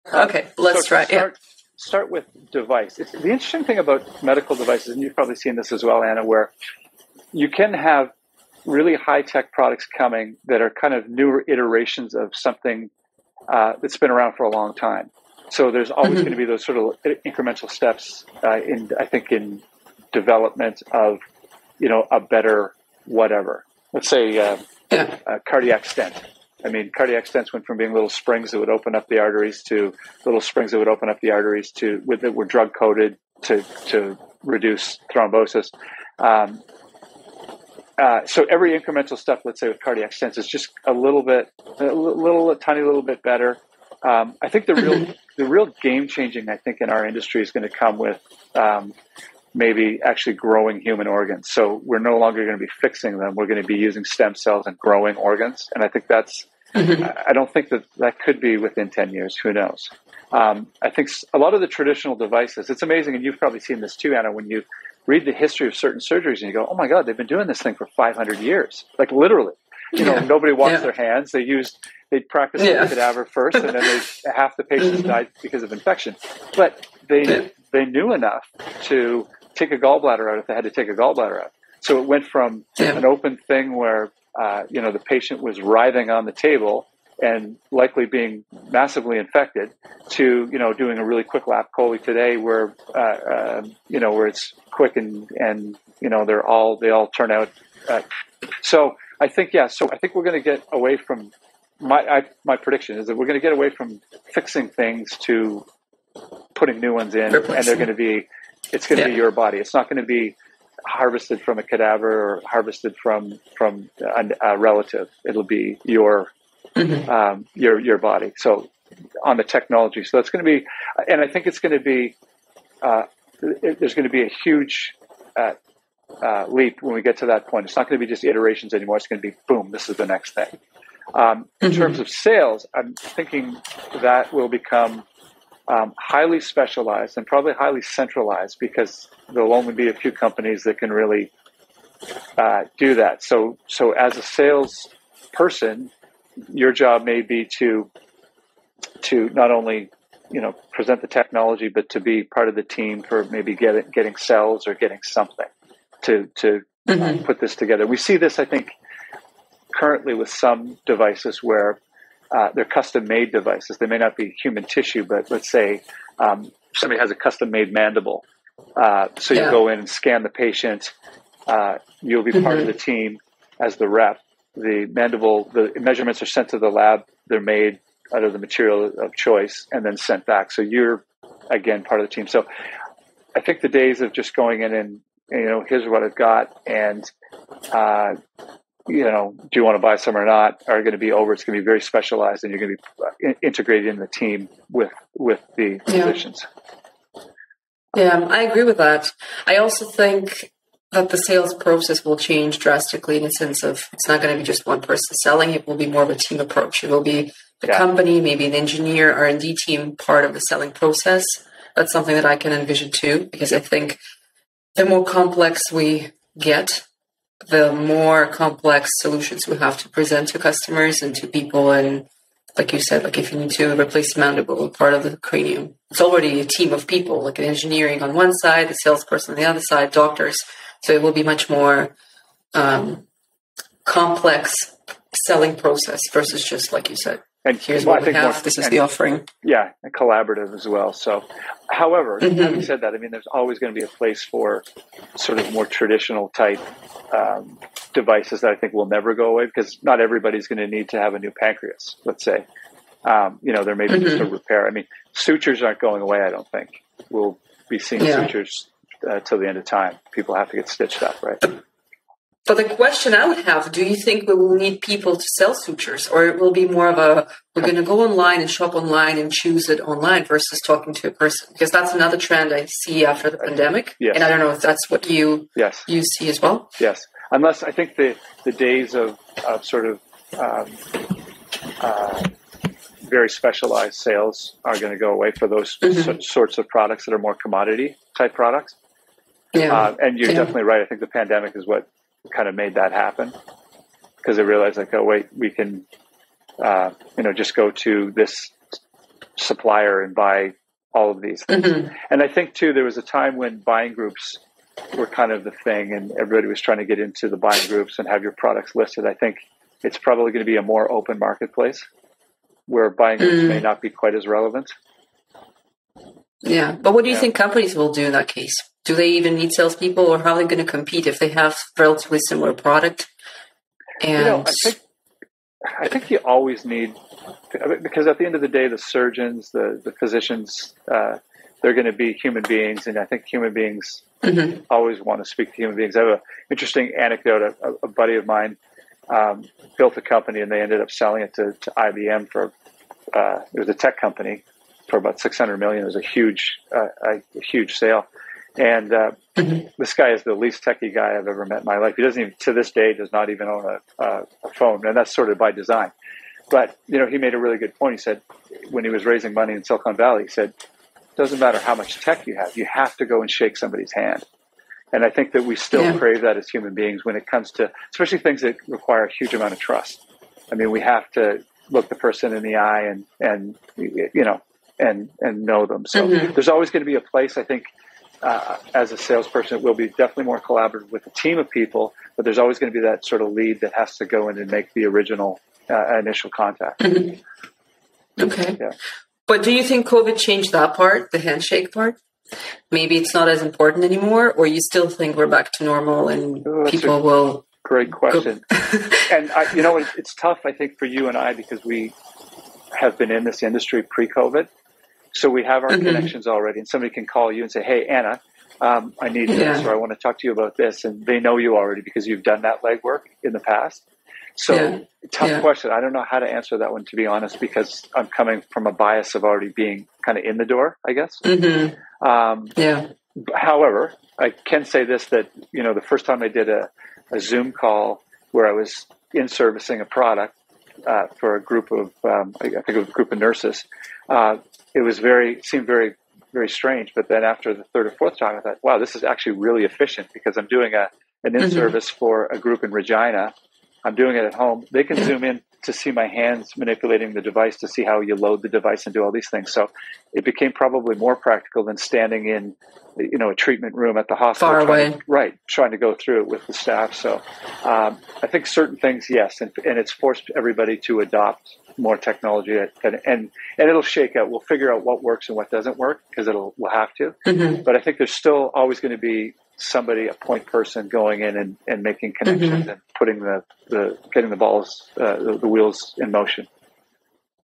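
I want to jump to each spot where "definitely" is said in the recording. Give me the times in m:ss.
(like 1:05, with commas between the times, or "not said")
4:50, 6:19.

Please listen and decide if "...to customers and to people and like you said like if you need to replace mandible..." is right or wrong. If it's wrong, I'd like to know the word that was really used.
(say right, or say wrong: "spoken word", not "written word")
right.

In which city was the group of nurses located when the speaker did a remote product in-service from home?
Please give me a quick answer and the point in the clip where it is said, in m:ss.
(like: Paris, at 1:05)
Regina, at 7:22.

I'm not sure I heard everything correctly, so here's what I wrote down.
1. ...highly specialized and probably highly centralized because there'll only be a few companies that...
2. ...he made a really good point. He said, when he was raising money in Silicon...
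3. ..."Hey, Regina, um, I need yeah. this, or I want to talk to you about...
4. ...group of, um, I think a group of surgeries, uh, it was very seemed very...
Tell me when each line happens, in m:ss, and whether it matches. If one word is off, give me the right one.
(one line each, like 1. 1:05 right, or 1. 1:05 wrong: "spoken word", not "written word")
1. 2:15 right
2. 5:57 right
3. 6:47 wrong: "Anna", not "Regina"
4. 7:11 wrong: "nurses", not "surgeries".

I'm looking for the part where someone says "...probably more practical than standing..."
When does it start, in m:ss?
7:30.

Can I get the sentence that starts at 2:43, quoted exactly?
They may not be human tissue, but let's say um, somebody has a custom made mandible.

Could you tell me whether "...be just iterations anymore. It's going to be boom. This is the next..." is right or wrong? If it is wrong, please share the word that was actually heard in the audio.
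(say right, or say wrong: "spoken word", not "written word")
right.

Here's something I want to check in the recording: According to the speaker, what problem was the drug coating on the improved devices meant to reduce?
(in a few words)
thrombosis.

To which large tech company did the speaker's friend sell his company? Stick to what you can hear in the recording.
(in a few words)
IBM.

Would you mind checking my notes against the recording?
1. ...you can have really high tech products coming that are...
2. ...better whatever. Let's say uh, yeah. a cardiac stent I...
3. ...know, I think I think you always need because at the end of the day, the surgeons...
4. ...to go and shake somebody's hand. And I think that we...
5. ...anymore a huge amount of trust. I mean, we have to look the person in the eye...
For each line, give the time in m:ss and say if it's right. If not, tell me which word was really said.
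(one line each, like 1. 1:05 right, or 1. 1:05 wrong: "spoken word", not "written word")
1. 0:07 right
2. 0:22 right
3. 5:24 right
4. 6:02 right
5. 6:08 wrong: "require", not "anymore".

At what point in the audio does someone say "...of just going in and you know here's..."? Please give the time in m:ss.
3:04.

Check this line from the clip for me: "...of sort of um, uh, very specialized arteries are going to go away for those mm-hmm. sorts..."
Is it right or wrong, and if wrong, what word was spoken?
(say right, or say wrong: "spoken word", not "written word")
wrong: "sales", not "arteries".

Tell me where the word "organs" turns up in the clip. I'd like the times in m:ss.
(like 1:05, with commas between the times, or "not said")
0:51, 0:55.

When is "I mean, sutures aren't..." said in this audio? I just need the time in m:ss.
4:14.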